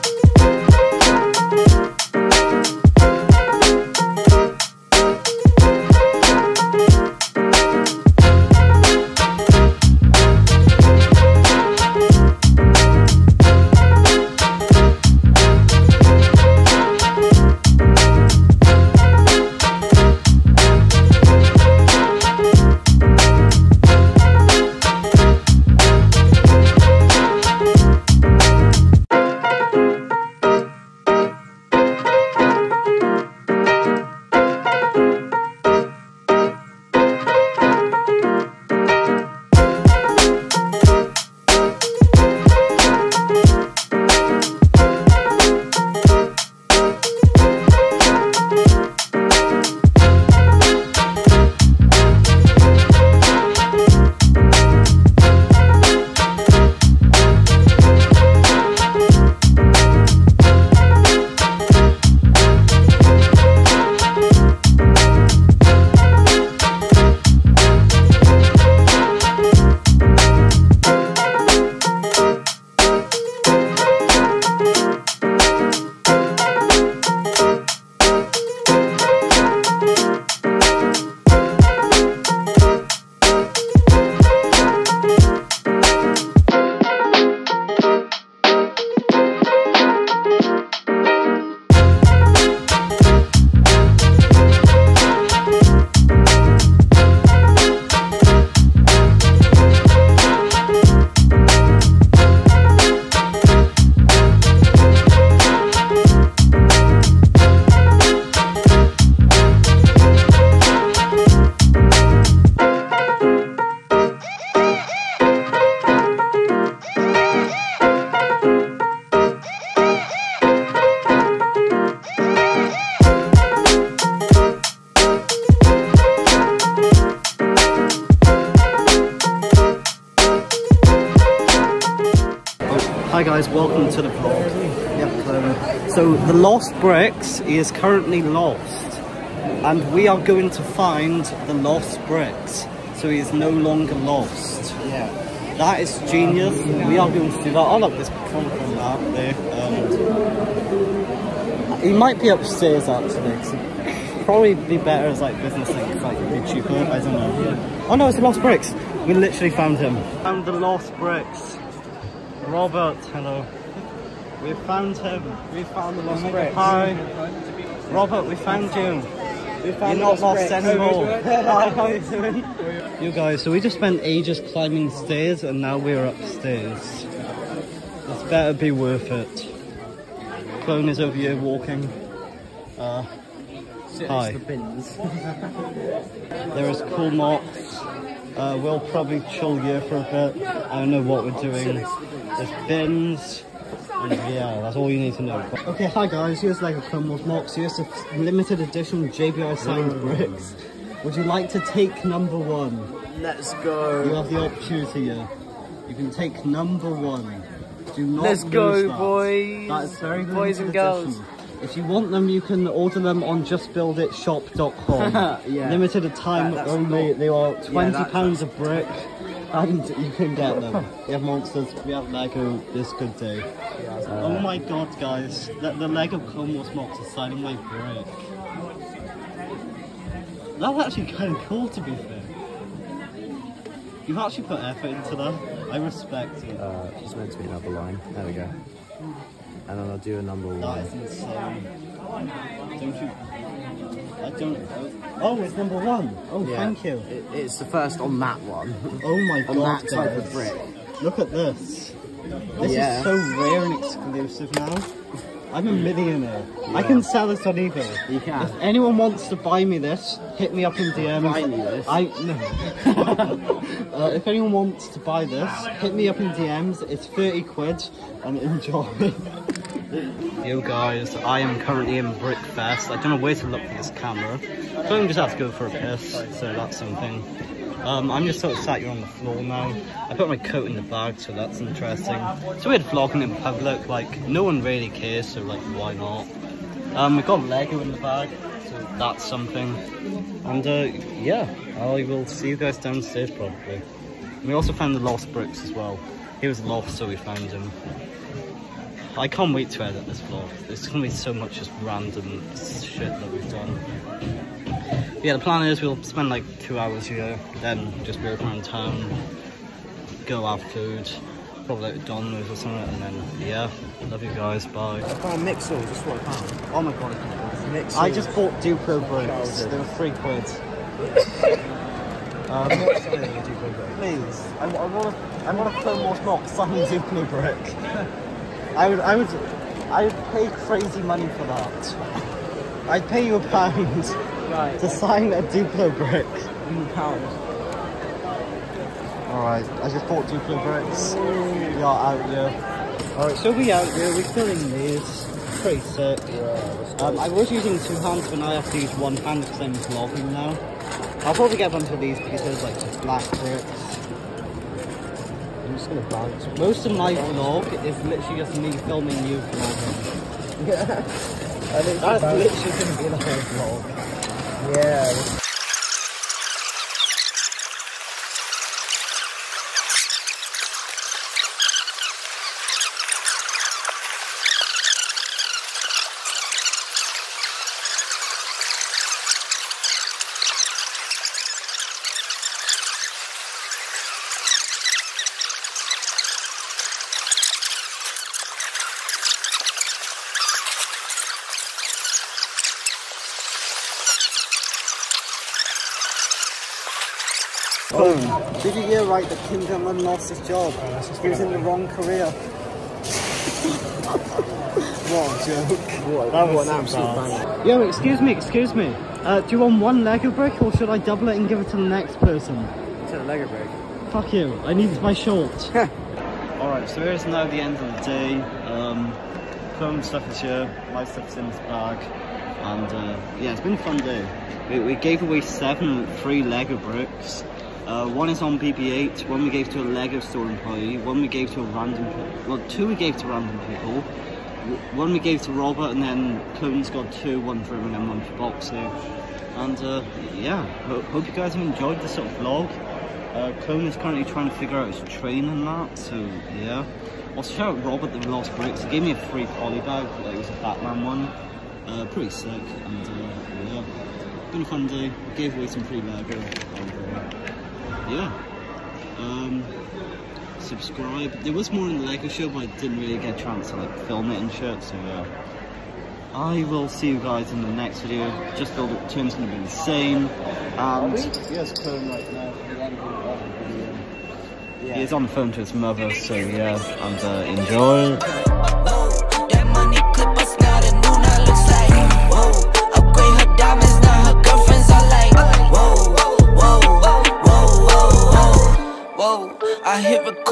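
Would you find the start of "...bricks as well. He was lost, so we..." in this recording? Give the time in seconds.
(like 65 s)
295 s.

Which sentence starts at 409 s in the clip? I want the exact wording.
Uh, do you want one Lego brick or should I double it and give it to the next person?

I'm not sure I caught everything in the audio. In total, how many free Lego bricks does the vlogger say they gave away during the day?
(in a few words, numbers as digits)
7.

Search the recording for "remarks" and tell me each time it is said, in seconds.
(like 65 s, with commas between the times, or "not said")
not said.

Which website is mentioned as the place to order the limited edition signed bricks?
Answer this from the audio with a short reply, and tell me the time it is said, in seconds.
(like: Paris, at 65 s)
justbuilditshop.com, at 213 s.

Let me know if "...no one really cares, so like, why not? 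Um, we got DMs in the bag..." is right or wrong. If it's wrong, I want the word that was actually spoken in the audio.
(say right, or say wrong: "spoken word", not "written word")
wrong: "Lego", not "DMs".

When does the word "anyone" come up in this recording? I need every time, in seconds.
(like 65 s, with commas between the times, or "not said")
258 s, 264 s.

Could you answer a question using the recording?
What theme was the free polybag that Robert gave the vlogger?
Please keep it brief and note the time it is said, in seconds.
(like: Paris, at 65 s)
Batman, at 450 s.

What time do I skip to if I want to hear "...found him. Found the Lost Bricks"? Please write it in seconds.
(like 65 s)
159 s.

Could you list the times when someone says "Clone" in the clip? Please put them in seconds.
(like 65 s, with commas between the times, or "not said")
180 s, 196 s, 226 s, 436 s, 443 s.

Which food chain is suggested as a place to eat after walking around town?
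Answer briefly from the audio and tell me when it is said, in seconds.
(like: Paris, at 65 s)
Domino's, at 312 s.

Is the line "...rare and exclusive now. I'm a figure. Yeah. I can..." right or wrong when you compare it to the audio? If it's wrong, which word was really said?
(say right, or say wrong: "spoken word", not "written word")
wrong: "millionaire", not "figure".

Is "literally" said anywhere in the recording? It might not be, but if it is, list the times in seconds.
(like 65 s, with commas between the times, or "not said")
159 s, 358 s, 362 s.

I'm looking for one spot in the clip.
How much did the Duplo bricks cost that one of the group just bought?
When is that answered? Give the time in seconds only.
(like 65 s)
319 s.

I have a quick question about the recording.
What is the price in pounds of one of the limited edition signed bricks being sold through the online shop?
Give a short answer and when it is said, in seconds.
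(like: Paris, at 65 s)
£20, at 217 s.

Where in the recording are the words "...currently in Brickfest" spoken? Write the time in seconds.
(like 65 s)
271 s.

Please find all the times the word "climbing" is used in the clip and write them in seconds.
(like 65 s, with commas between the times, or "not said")
174 s.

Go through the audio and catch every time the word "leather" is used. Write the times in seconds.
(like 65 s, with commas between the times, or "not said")
not said.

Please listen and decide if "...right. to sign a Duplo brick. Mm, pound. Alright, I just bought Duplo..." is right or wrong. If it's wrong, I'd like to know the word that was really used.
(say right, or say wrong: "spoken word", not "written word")
right.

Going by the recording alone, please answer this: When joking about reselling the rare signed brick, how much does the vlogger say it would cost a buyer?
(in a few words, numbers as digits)
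30 quid.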